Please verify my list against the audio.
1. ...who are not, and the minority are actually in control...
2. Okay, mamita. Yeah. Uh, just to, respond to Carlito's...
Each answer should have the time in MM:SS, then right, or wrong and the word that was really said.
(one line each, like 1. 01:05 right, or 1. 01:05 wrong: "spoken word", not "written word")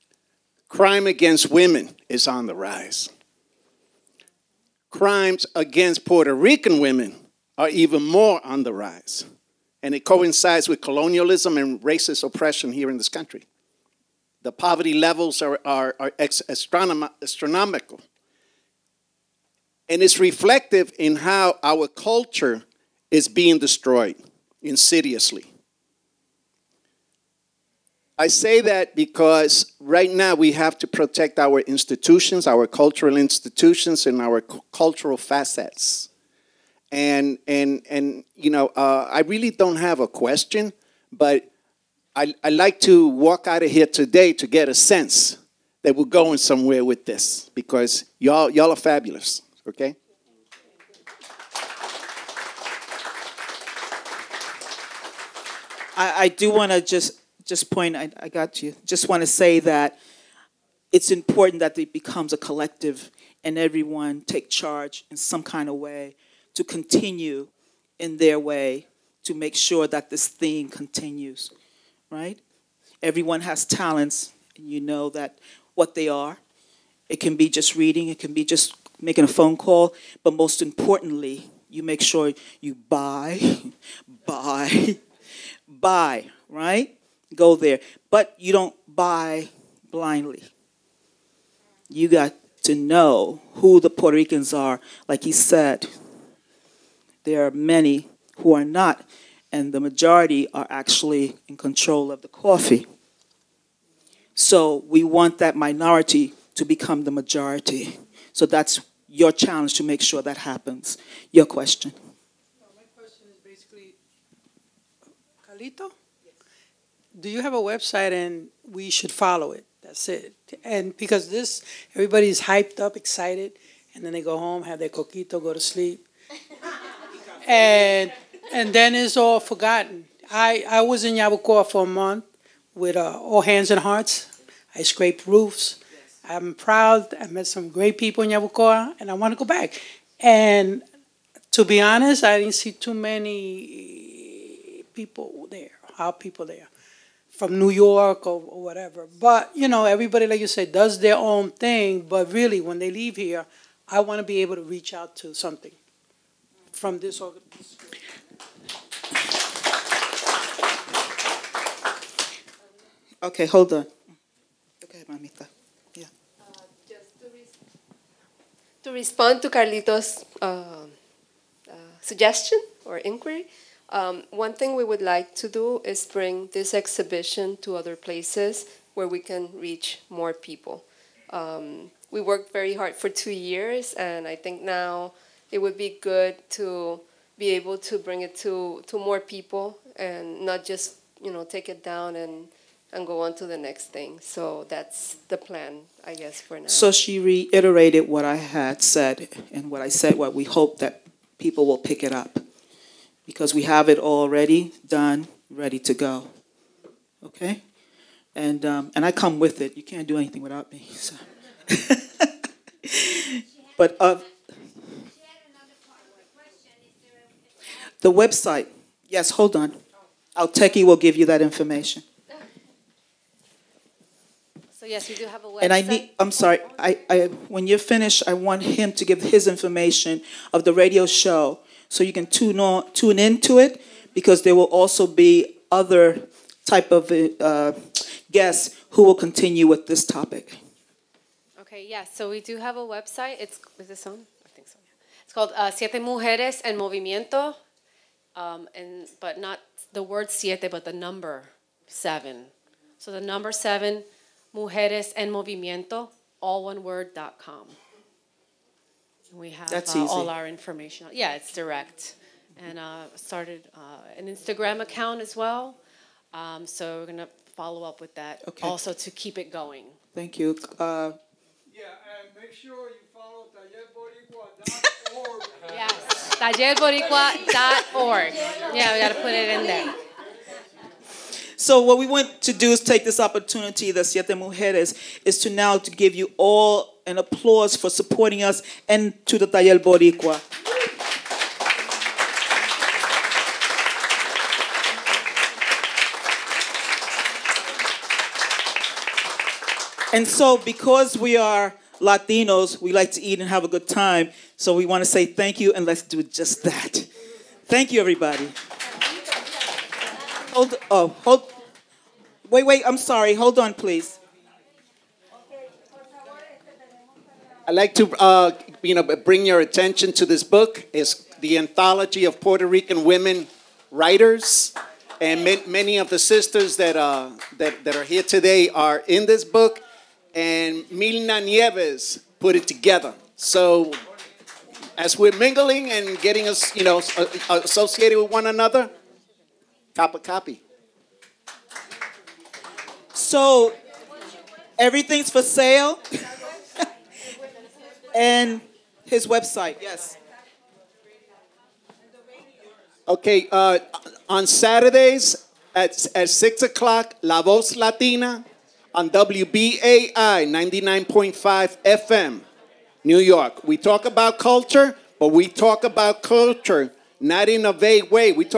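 1. 01:38 wrong: "majority", not "minority"
2. 02:44 right.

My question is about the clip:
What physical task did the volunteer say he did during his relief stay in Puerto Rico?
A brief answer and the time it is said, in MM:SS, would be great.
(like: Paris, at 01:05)
scraped roofs, at 02:14.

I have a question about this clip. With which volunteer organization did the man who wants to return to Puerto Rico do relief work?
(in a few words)
All Hands and Hearts.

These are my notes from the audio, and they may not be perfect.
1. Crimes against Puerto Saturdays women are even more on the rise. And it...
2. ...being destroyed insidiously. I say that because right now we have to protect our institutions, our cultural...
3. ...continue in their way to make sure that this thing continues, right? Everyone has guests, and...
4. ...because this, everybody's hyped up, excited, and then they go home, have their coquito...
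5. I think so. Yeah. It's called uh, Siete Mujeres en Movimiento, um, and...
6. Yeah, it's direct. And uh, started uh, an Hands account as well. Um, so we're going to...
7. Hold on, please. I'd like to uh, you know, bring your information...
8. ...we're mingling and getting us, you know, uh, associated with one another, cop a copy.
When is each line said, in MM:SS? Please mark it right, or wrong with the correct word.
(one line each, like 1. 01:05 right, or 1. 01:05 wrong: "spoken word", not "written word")
1. 00:04 wrong: "Rican", not "Saturdays"
2. 00:23 right
3. 01:06 wrong: "talents", not "guests"
4. 02:00 right
5. 04:04 right
6. 04:21 wrong: "Instagram", not "Hands"
7. 05:13 wrong: "attention", not "information"
8. 05:35 right.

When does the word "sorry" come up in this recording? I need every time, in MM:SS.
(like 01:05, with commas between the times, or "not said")
03:46, 05:12.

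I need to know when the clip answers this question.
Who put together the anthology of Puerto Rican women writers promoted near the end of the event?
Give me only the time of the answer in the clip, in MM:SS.
05:30.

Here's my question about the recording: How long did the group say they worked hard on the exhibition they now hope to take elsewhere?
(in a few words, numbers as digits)
2 years.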